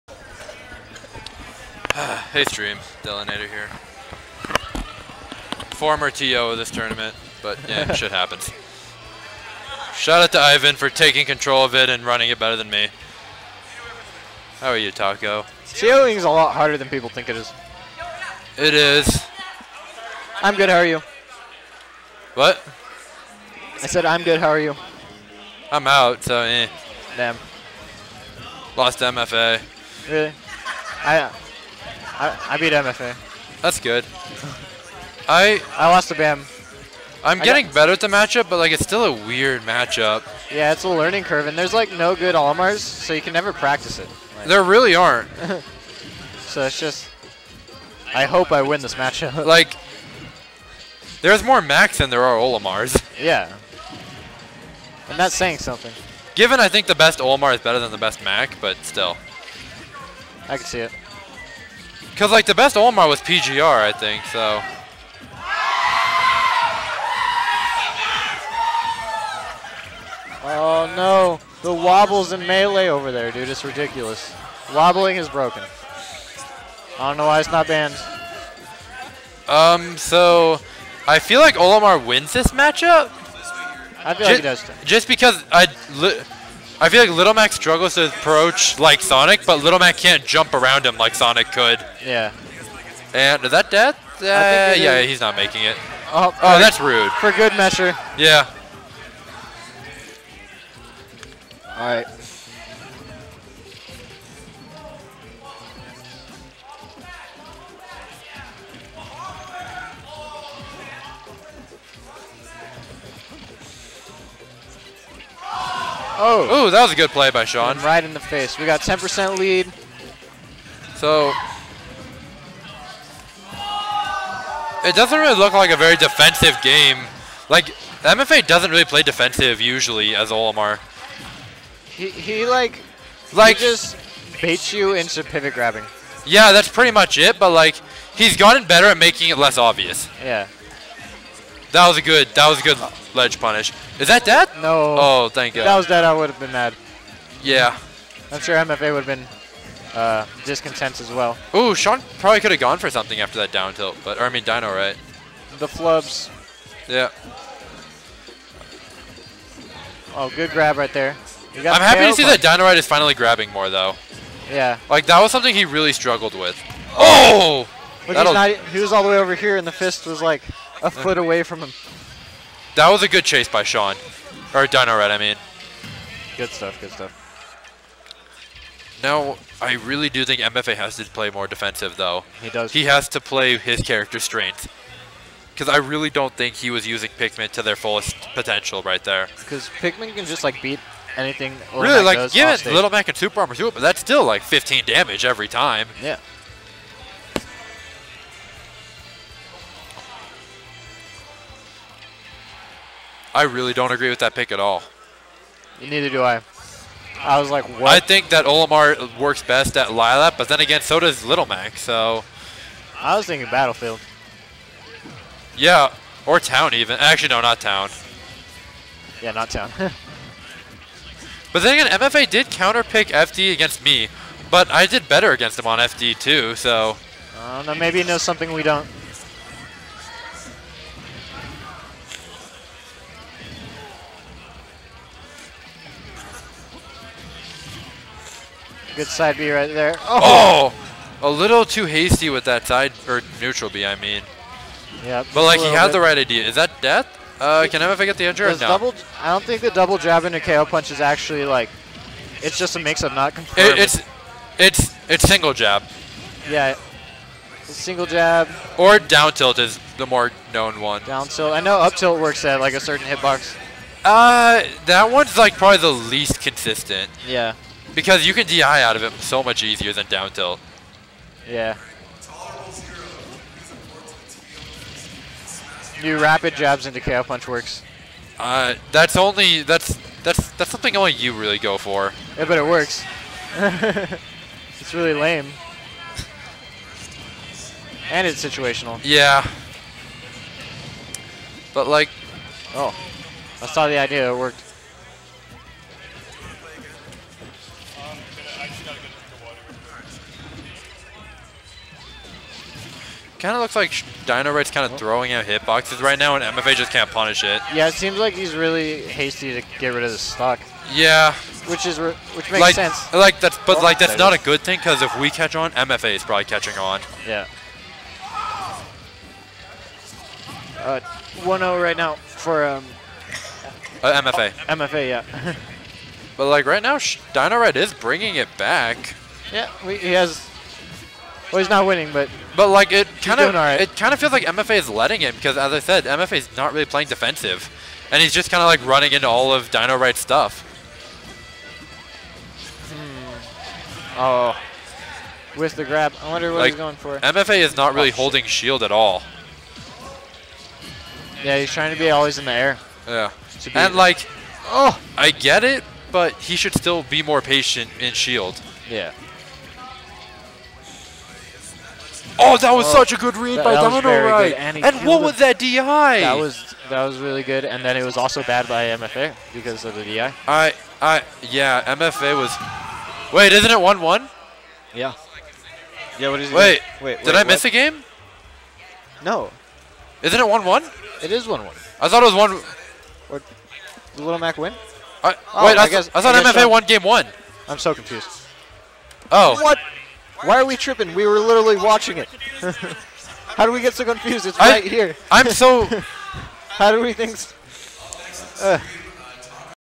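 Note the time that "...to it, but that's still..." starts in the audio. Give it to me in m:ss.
3:13.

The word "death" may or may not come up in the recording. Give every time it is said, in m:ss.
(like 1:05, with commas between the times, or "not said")
1:33, 4:06.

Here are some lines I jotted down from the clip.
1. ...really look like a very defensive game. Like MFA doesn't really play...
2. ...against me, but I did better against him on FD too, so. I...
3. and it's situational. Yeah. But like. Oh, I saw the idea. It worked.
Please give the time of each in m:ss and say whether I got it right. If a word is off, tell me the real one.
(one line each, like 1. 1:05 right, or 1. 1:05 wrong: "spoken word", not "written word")
1. 2:05 right
2. 3:43 right
3. 4:48 right.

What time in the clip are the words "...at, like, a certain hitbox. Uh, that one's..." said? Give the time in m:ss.
4:22.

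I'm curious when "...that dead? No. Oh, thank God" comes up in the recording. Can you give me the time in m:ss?
2:24.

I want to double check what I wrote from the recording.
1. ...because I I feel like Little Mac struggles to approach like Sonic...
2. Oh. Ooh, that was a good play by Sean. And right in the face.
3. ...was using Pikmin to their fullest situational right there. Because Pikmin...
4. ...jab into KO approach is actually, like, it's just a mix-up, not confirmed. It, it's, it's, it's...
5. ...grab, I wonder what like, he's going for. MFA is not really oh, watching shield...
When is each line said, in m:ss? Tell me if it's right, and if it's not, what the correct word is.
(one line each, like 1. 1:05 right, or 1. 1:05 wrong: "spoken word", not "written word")
1. 1:25 right
2. 1:56 right
3. 3:06 wrong: "potential", not "situational"
4. 4:09 wrong: "punch", not "approach"
5. 5:45 wrong: "holding", not "watching".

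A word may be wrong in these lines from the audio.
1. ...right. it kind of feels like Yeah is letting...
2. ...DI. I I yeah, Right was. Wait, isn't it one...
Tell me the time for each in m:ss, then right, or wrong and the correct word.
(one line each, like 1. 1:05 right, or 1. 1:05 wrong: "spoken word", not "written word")
1. 5:33 wrong: "MFA", not "Yeah"
2. 6:10 wrong: "MFA", not "Right".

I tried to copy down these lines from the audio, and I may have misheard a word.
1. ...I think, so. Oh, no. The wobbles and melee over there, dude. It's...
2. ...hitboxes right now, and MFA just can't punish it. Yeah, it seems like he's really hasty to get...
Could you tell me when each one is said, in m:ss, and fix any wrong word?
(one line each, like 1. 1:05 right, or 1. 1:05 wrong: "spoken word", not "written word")
1. 1:03 right
2. 5:05 right.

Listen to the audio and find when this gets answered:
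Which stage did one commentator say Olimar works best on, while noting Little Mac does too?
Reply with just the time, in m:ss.
3:29.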